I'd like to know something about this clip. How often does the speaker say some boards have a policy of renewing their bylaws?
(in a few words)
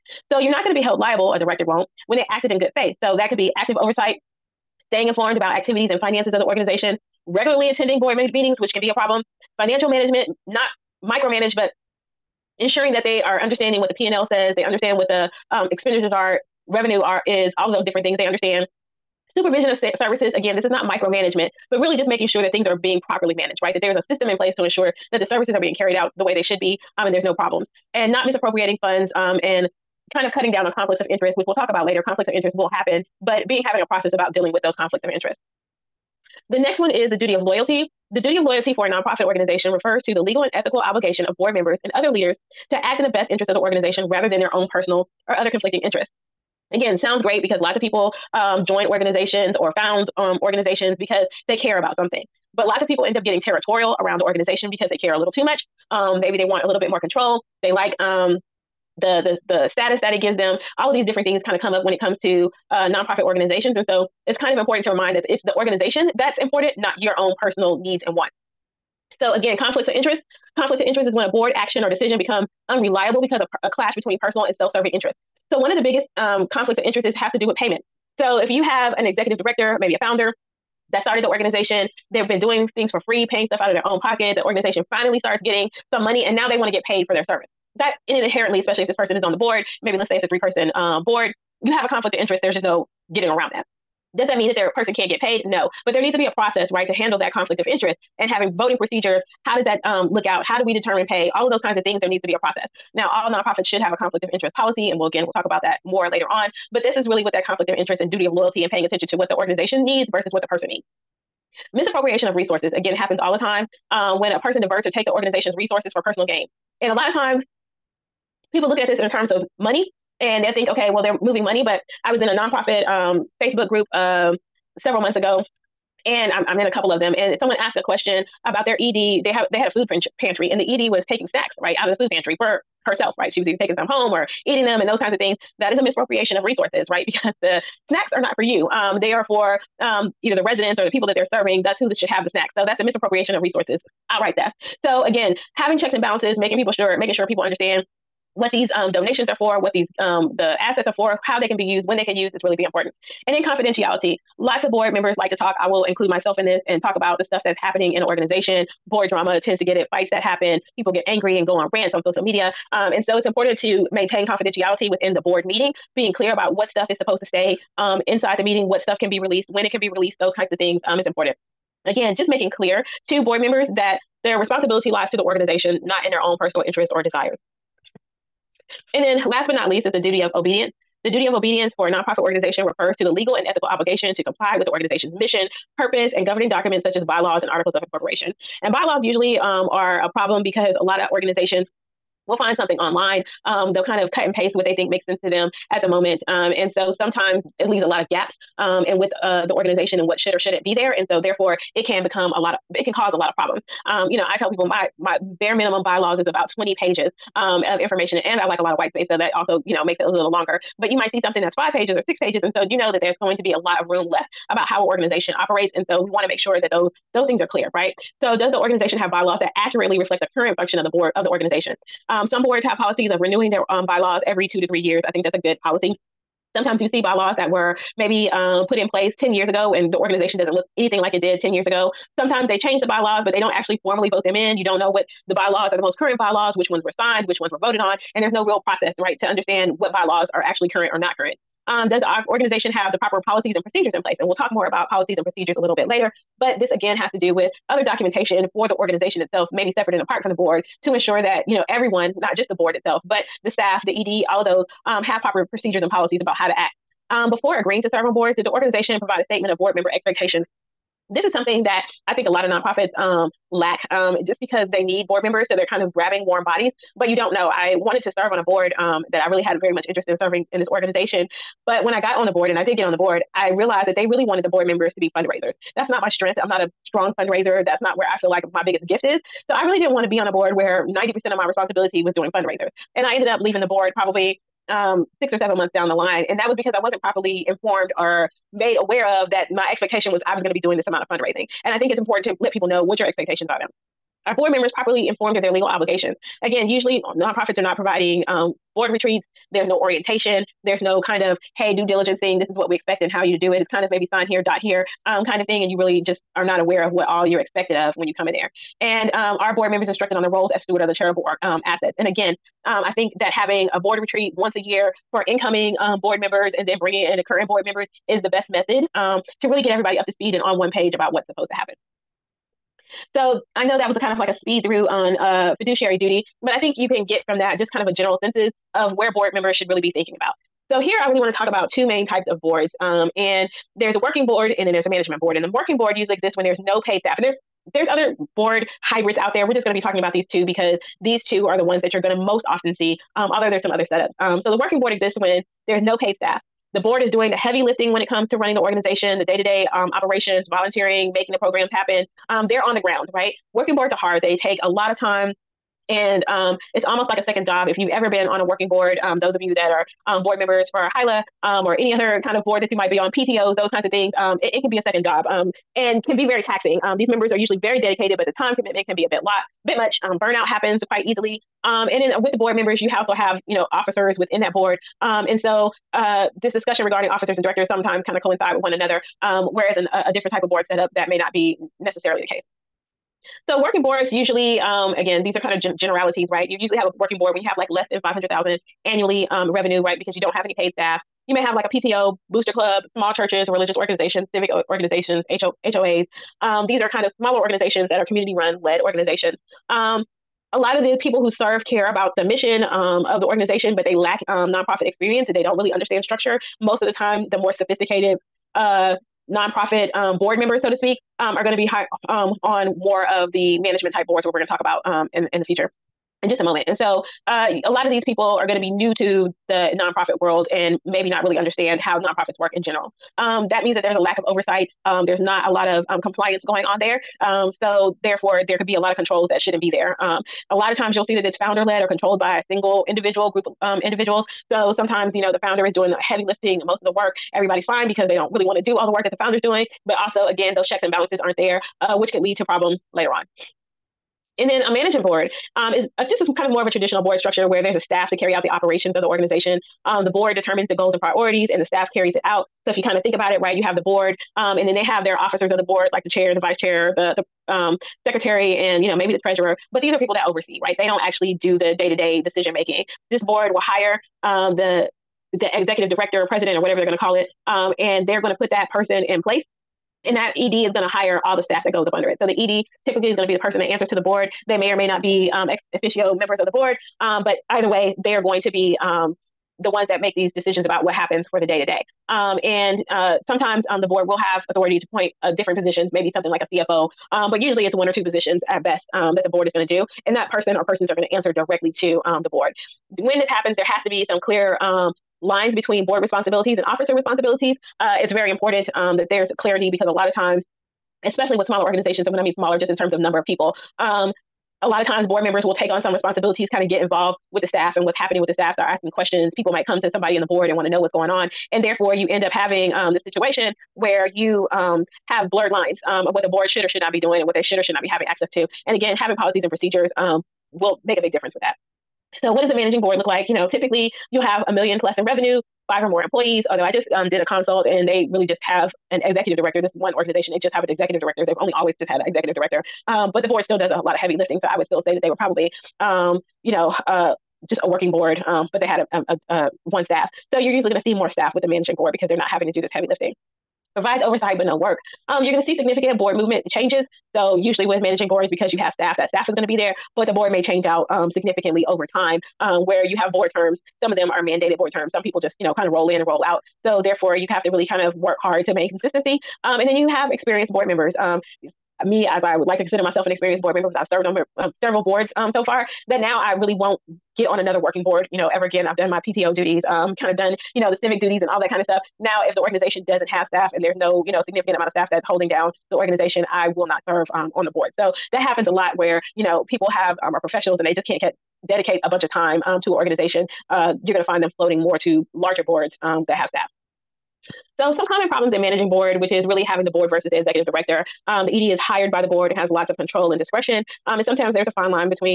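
every 2 to 3 years.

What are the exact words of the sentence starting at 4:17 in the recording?
Um, before agreeing to serve on boards, did the organization provide a statement of board member expectations?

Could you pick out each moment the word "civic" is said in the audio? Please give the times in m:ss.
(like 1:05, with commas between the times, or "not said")
6:34, 9:30.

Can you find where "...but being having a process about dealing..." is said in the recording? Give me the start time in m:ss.
0:33.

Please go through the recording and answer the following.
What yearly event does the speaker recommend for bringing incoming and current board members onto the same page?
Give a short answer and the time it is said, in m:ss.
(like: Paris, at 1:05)
a board retreat, at 5:13.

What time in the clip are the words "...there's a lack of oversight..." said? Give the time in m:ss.
7:03.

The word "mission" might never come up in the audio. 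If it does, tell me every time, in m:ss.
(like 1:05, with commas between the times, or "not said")
3:05, 6:42.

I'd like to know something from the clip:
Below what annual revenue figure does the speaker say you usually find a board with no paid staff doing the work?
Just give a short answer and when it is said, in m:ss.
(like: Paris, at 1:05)
$500,000, at 6:28.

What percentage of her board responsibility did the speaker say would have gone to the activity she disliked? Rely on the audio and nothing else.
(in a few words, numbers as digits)
90%.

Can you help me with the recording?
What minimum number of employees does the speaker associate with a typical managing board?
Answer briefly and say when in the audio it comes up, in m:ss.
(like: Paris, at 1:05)
5, at 8:45.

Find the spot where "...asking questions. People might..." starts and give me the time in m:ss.
8:28.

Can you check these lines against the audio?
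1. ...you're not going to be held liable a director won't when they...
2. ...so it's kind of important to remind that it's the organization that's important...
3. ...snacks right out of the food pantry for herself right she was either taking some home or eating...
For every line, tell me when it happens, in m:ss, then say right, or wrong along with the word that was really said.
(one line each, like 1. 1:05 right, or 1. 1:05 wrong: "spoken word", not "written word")
1. 0:00 right
2. 1:03 right
3. 2:11 right.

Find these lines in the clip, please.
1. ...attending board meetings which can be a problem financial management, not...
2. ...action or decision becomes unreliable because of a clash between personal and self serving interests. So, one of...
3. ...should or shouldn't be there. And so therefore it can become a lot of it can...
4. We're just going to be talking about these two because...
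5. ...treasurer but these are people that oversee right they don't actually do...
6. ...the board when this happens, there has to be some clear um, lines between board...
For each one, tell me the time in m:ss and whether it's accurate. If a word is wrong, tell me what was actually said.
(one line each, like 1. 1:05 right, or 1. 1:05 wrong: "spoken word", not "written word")
1. 0:07 right
2. 1:11 right
3. 3:20 right
4. 5:39 right
5. 7:39 right
6. 8:12 right.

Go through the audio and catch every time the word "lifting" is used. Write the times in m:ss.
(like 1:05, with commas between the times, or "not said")
5:47, 7:16, 8:54, 9:02.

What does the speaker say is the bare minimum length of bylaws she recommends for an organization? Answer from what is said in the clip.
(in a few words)
about 20 pages.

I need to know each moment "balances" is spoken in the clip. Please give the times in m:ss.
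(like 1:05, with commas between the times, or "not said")
2:26, 7:20.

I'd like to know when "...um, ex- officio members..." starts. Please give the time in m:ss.
7:55.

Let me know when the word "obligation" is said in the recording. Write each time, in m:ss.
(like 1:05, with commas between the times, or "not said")
0:40, 3:03, 4:55.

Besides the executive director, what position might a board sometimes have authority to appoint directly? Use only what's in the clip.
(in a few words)
CFO.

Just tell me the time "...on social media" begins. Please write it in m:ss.
2:41.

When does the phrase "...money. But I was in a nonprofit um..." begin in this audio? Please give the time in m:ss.
2:01.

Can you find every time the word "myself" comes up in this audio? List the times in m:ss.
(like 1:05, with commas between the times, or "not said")
2:36, 9:22.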